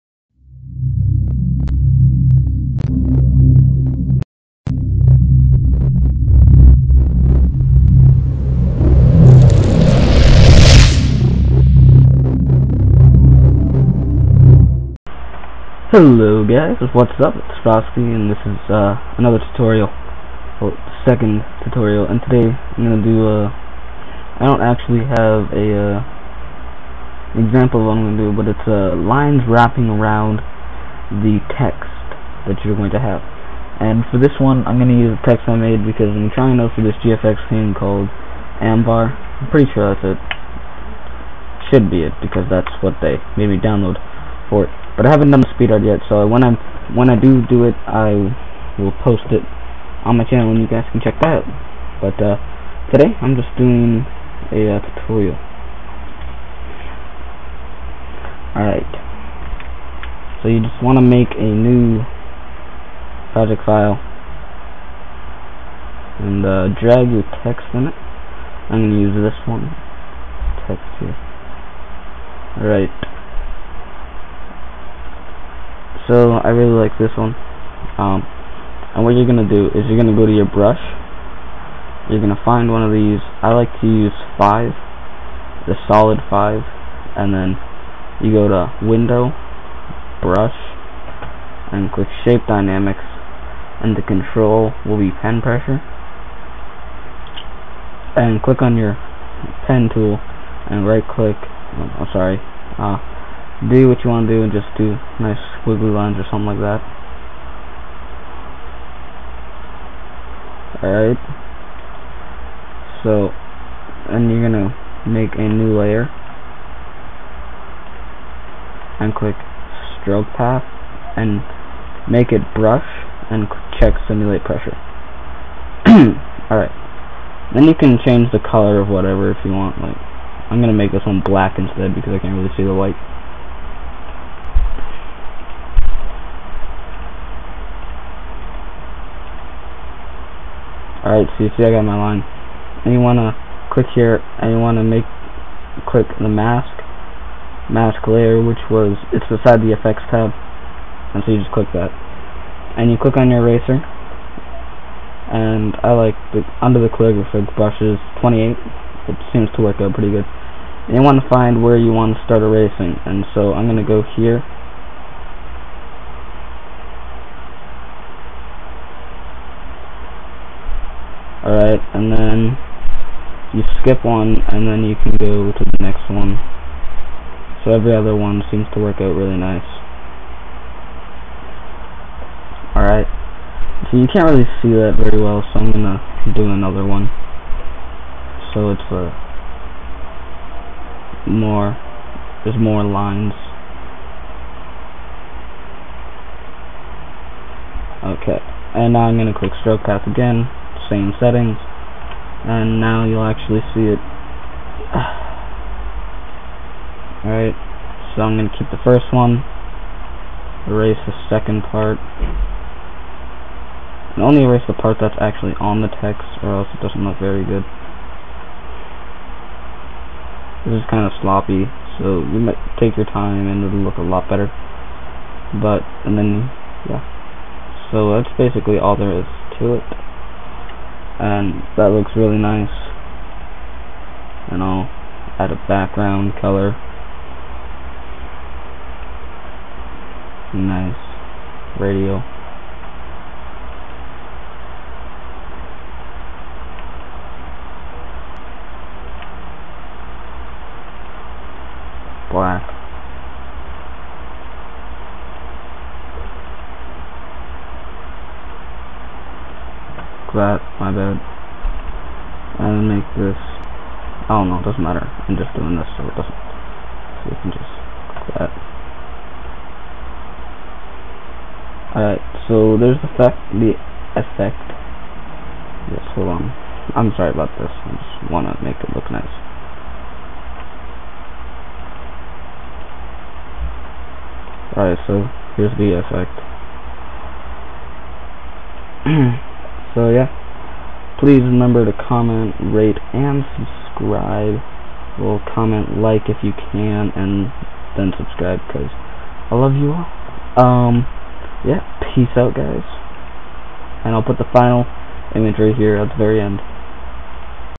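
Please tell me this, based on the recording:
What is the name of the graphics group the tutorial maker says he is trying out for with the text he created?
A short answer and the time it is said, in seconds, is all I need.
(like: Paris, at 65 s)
Ambar, at 38 s.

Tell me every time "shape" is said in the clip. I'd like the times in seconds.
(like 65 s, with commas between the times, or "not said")
92 s.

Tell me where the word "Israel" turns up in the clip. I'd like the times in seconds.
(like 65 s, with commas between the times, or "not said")
not said.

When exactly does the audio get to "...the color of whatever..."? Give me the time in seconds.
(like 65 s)
128 s.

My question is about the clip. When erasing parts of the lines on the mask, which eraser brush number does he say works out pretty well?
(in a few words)
28.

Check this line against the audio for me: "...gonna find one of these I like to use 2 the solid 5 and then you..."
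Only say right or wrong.
wrong.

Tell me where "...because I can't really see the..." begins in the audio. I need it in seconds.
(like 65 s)
131 s.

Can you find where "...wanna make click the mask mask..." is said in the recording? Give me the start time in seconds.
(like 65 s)
144 s.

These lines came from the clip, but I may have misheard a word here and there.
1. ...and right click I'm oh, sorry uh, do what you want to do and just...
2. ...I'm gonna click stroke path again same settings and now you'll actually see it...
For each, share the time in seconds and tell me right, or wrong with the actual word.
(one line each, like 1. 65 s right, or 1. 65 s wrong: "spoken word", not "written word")
1. 100 s right
2. 199 s right.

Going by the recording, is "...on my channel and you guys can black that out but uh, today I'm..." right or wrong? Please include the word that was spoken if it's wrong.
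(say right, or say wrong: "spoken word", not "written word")
wrong: "check", not "black".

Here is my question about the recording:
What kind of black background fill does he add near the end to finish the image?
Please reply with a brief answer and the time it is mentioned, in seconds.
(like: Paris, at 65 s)
Radial black, at 241 s.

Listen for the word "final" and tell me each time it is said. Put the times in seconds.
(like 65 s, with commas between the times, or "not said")
304 s.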